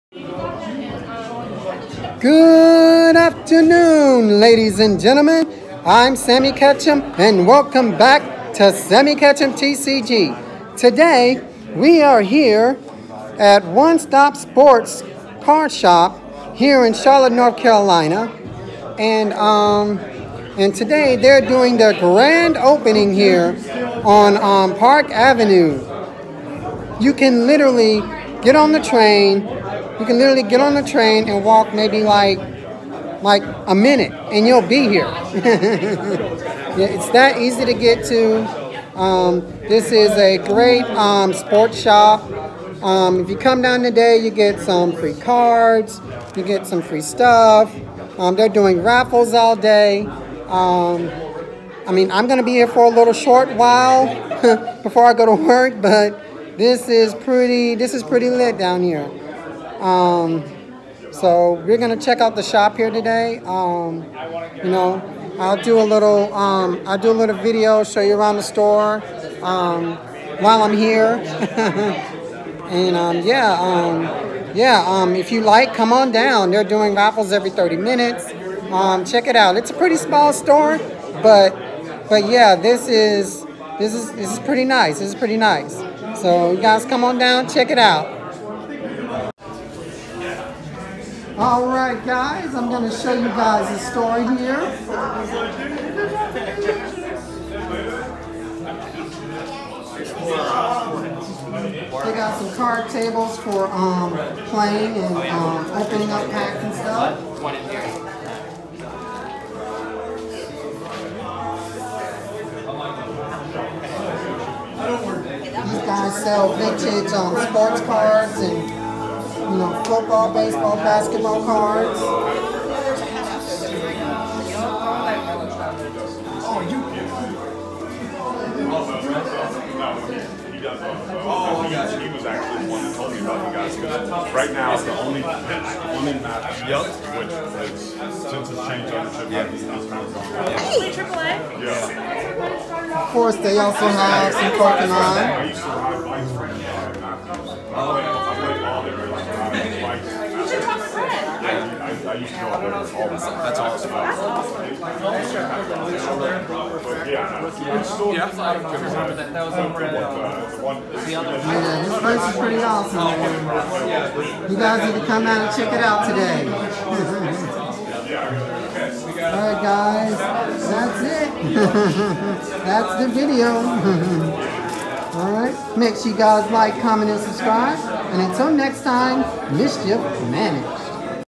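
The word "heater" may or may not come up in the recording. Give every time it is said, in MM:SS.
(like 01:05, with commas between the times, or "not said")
not said.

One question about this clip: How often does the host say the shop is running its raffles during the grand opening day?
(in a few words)
Every 30 minutes.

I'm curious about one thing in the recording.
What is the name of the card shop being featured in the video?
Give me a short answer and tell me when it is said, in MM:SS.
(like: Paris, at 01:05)
One Stop Sports Card Shop, at 00:13.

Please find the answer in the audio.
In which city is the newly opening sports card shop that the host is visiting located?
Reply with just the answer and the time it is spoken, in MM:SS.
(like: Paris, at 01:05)
Charlotte, North Carolina, at 00:16.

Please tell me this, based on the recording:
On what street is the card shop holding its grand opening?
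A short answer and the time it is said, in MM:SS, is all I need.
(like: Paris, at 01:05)
Park Avenue, at 00:24.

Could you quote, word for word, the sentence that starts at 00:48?
Um, they're doing raffles all day.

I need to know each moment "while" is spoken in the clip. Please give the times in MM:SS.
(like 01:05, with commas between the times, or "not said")
00:53, 01:10.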